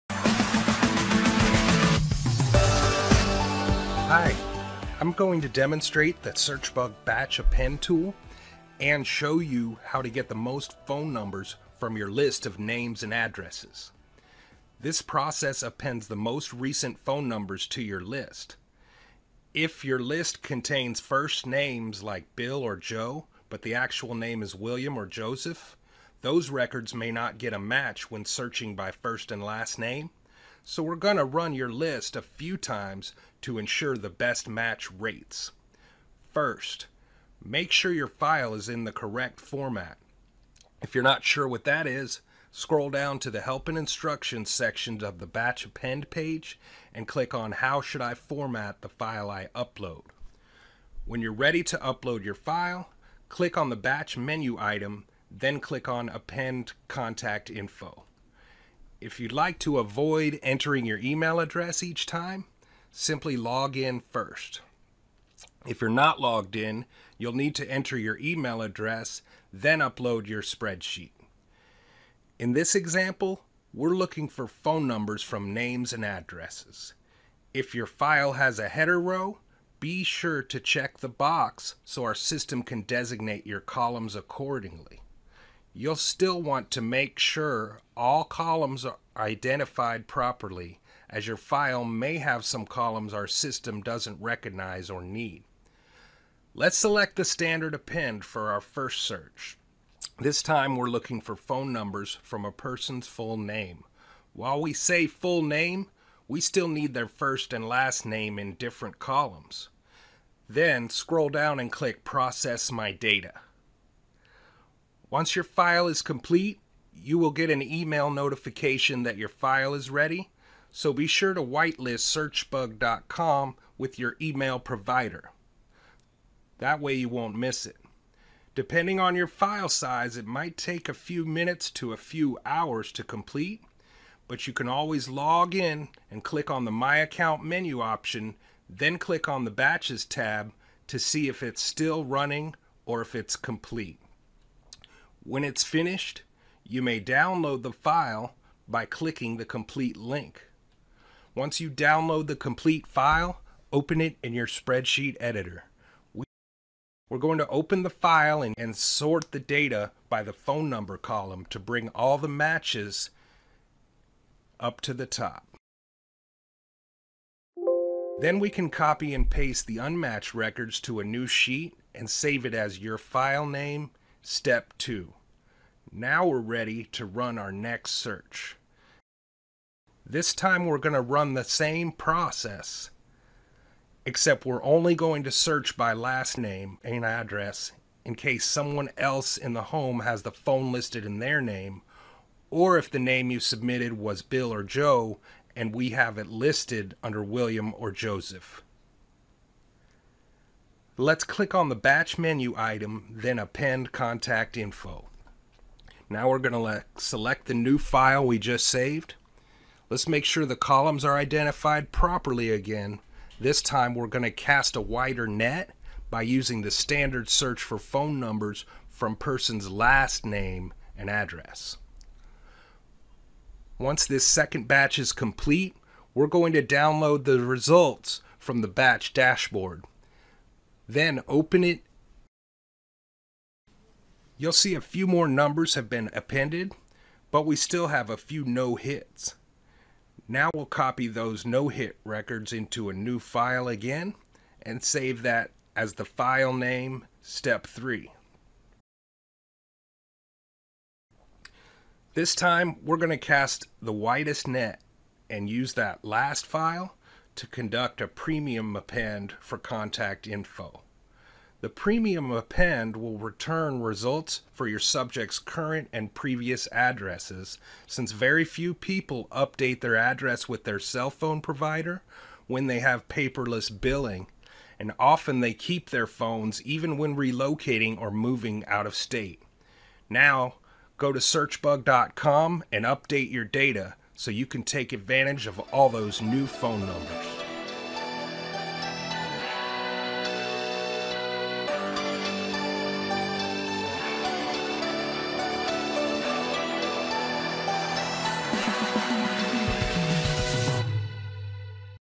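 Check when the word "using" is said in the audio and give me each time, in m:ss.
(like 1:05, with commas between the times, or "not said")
3:36.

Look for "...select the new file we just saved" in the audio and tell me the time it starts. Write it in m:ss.
3:26.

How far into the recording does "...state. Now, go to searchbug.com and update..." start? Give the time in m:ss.
4:38.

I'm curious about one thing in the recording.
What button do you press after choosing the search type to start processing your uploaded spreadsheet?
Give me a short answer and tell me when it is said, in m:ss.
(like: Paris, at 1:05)
Process My Data, at 1:52.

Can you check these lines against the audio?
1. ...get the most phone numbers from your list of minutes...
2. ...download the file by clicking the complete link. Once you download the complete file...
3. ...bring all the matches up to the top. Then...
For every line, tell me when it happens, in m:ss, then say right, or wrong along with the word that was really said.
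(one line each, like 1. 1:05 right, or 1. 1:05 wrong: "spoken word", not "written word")
1. 0:10 wrong: "names", not "minutes"
2. 2:26 right
3. 2:41 right.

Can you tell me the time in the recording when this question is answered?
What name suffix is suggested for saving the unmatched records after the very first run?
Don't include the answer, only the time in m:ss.
2:54.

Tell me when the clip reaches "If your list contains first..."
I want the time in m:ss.
0:19.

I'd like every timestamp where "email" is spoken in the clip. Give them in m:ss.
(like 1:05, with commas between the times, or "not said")
1:00, 1:08, 1:57, 2:04.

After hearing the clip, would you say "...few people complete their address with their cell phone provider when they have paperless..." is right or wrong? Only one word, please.
wrong.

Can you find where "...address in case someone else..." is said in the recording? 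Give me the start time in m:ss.
3:07.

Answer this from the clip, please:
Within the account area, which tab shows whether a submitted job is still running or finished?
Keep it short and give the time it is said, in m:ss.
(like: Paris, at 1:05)
Batches, at 2:19.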